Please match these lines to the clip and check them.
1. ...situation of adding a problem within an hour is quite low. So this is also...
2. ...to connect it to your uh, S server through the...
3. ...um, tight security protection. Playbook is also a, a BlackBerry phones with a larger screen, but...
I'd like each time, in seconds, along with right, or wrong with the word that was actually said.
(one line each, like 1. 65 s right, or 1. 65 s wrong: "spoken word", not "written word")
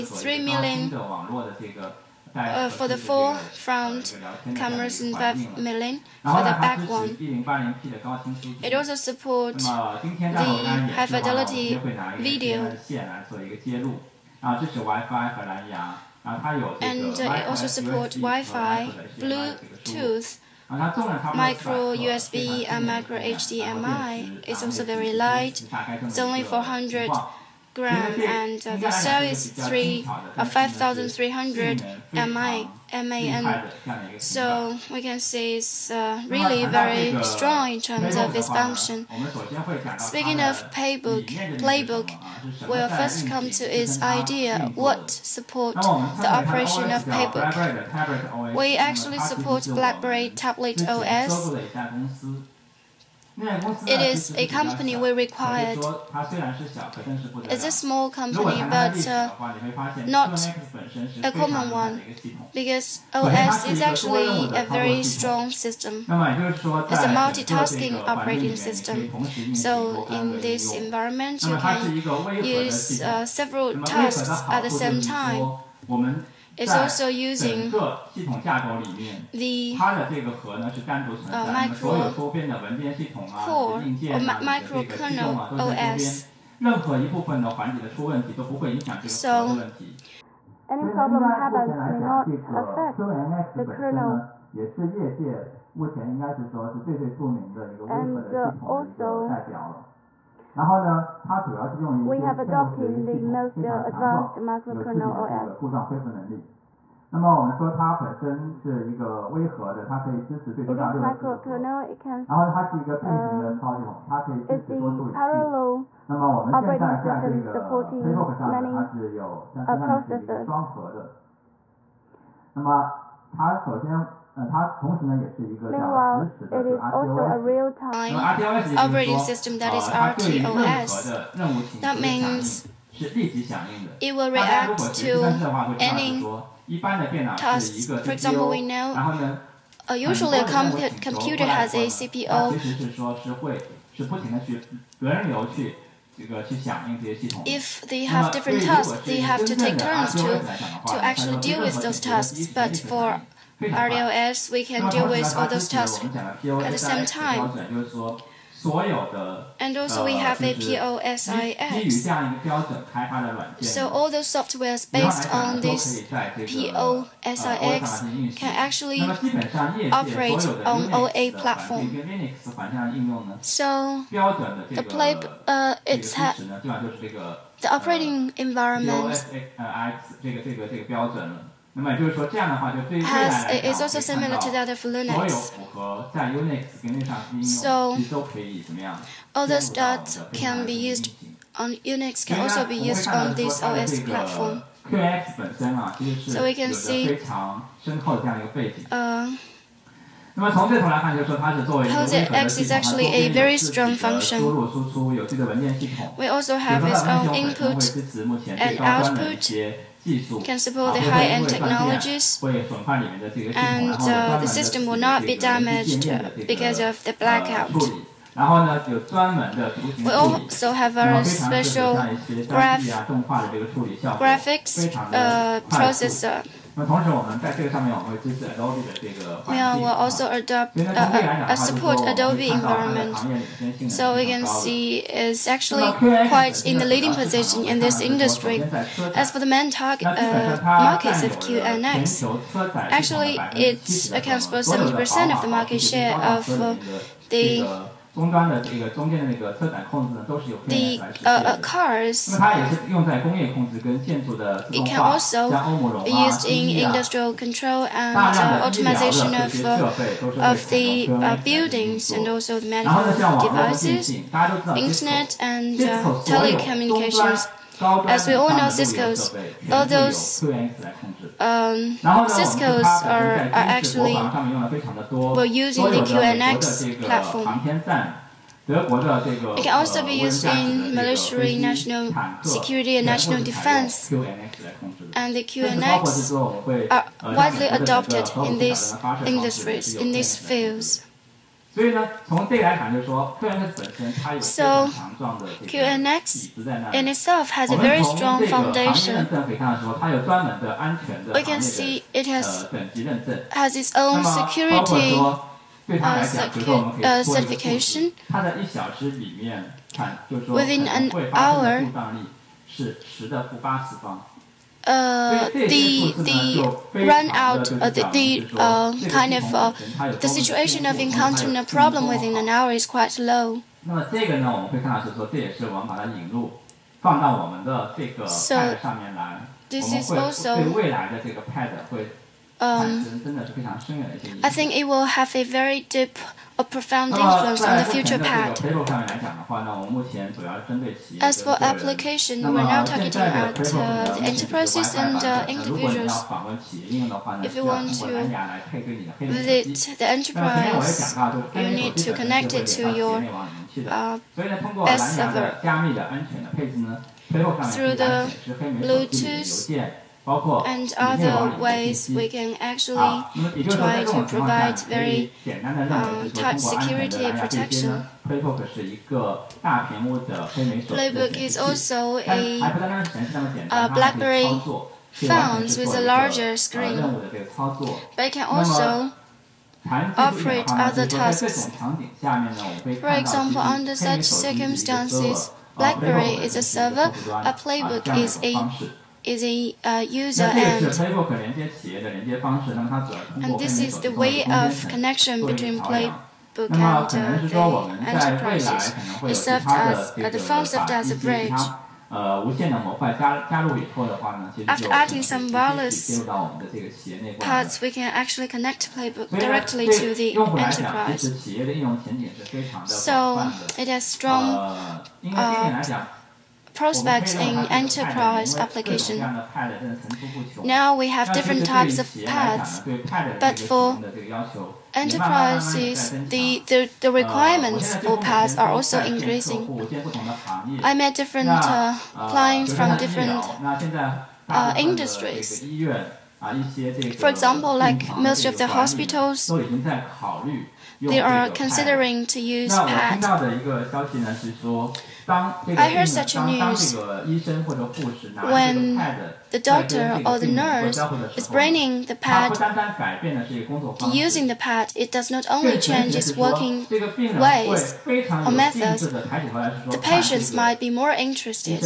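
1. 320 s wrong: "encountering", not "adding"
2. 352 s right
3. 365 s right.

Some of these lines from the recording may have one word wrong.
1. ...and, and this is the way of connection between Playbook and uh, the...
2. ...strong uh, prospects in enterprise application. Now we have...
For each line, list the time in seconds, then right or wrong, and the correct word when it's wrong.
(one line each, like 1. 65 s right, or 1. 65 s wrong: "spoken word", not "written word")
1. 390 s right
2. 414 s right.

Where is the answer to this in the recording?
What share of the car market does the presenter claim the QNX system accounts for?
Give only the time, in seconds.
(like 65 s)
244 s.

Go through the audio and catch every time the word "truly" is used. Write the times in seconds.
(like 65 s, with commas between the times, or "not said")
not said.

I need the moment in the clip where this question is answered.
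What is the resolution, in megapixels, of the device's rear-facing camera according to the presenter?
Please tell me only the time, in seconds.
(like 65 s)
5 s.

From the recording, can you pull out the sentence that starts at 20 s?
Uh, micro USB and uh, micro HDMI is also very light.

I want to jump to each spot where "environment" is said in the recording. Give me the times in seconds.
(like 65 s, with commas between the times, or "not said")
70 s, 178 s, 232 s.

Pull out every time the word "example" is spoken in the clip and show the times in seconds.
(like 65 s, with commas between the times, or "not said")
138 s, 383 s, 437 s.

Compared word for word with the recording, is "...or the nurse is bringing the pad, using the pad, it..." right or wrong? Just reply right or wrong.
right.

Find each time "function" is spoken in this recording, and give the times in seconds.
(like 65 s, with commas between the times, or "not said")
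38 s, 203 s.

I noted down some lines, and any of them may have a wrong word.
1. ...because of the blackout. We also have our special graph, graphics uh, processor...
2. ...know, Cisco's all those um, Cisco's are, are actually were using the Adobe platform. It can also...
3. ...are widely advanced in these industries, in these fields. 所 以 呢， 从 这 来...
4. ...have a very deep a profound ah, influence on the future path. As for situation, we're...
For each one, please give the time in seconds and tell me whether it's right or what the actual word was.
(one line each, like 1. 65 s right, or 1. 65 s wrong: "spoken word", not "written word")
1. 216 s right
2. 268 s wrong: "QNX", not "Adobe"
3. 286 s wrong: "adopted", not "advanced"
4. 335 s wrong: "application", not "situation".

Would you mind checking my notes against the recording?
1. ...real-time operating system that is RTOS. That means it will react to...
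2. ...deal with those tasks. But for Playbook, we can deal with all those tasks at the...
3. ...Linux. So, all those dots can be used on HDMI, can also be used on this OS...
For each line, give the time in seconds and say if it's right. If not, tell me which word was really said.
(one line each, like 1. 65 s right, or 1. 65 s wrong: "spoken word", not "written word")
1. 127 s right
2. 151 s wrong: "RTOS", not "Playbook"
3. 184 s wrong: "Unix", not "HDMI".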